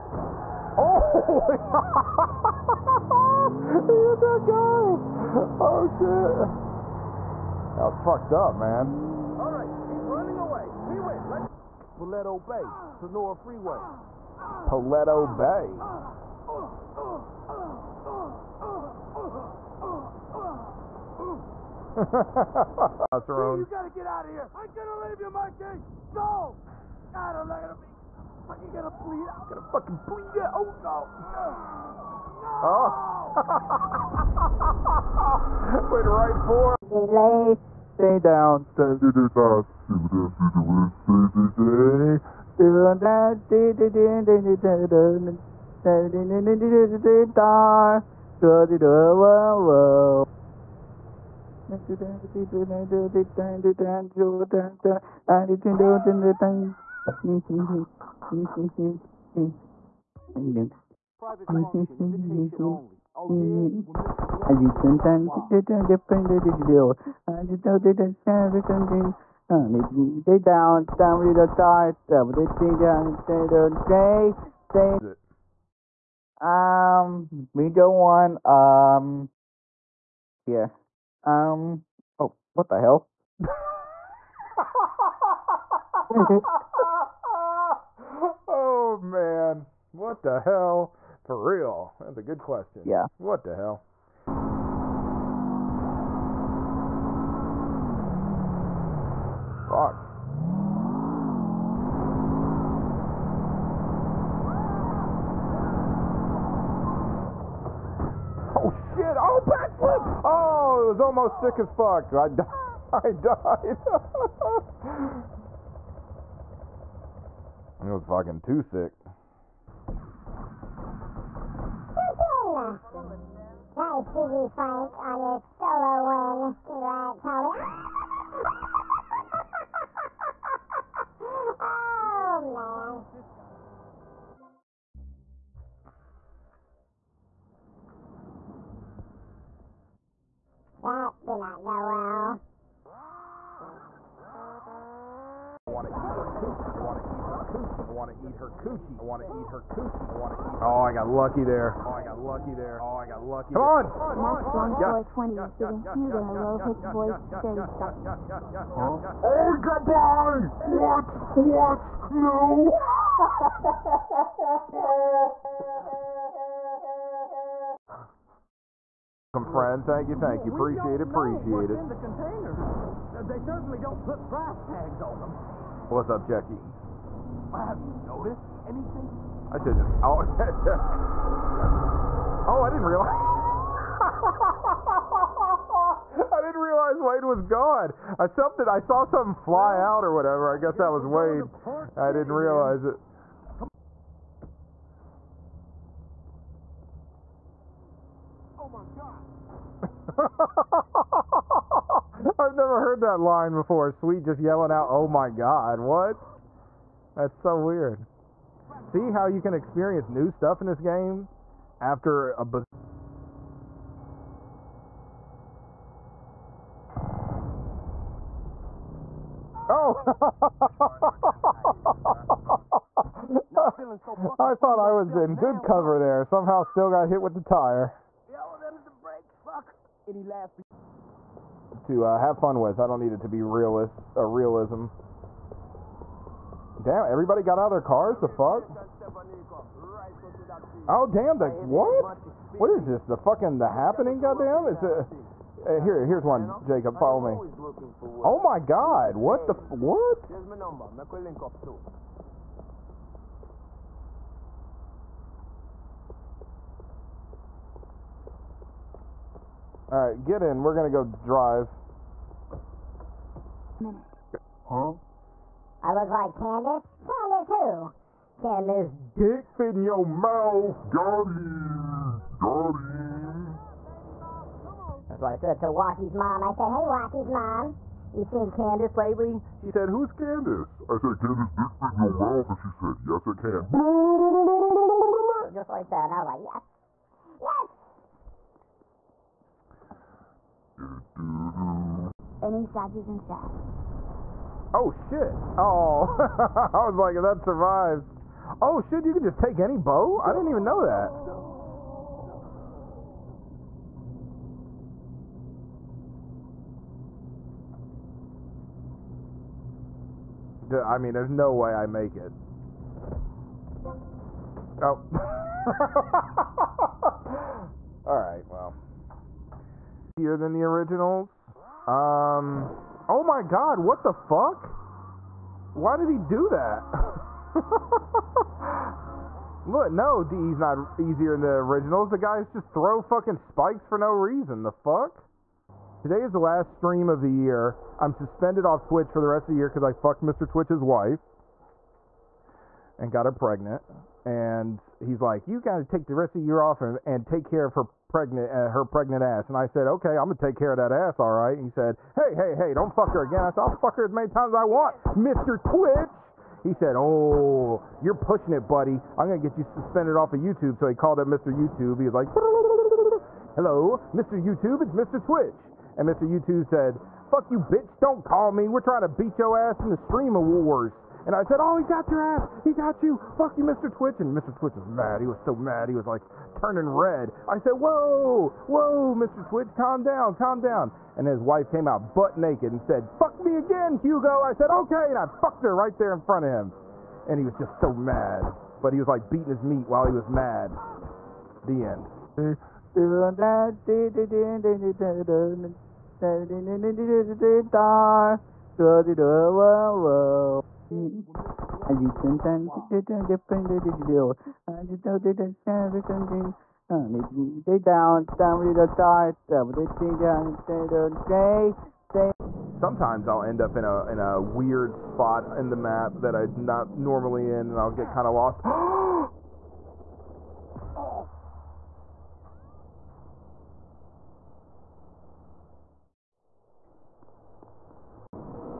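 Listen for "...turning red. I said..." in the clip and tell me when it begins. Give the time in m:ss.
6:16.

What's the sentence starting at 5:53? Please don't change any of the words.
I said, I'll fuck her as many times as I want, Mr.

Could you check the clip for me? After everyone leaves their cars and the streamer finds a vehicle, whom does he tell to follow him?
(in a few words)
Jacob.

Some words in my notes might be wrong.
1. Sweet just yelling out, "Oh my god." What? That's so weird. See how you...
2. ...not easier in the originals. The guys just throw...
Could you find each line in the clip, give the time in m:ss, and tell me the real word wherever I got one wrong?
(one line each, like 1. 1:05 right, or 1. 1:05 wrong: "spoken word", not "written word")
1. 3:23 right
2. 5:30 right.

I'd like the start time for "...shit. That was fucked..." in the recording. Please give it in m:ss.
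0:05.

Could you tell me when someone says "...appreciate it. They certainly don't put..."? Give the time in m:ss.
2:51.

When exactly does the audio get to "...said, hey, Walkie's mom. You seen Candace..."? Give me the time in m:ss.
4:36.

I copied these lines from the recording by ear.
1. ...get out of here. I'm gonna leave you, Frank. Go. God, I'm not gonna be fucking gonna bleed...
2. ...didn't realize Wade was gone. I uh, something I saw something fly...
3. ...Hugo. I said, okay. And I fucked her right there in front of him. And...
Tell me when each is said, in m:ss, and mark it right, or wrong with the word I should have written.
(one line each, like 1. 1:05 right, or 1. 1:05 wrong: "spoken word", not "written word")
1. 0:23 wrong: "Mikey", not "Frank"
2. 3:06 right
3. 6:23 right.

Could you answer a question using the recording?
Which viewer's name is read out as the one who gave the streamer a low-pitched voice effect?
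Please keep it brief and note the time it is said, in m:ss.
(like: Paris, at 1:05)
Max Bone 420, at 2:34.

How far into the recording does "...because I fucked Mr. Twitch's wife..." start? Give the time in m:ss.
5:39.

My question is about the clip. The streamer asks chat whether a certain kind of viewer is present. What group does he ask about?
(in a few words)
Sages.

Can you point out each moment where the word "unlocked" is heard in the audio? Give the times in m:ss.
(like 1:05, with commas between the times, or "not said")
not said.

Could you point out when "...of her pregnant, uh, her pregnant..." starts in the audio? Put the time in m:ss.
5:47.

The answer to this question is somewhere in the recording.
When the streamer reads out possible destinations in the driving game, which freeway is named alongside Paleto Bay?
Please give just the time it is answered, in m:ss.
0:12.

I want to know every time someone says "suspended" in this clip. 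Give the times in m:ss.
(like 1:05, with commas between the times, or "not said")
5:38, 5:59.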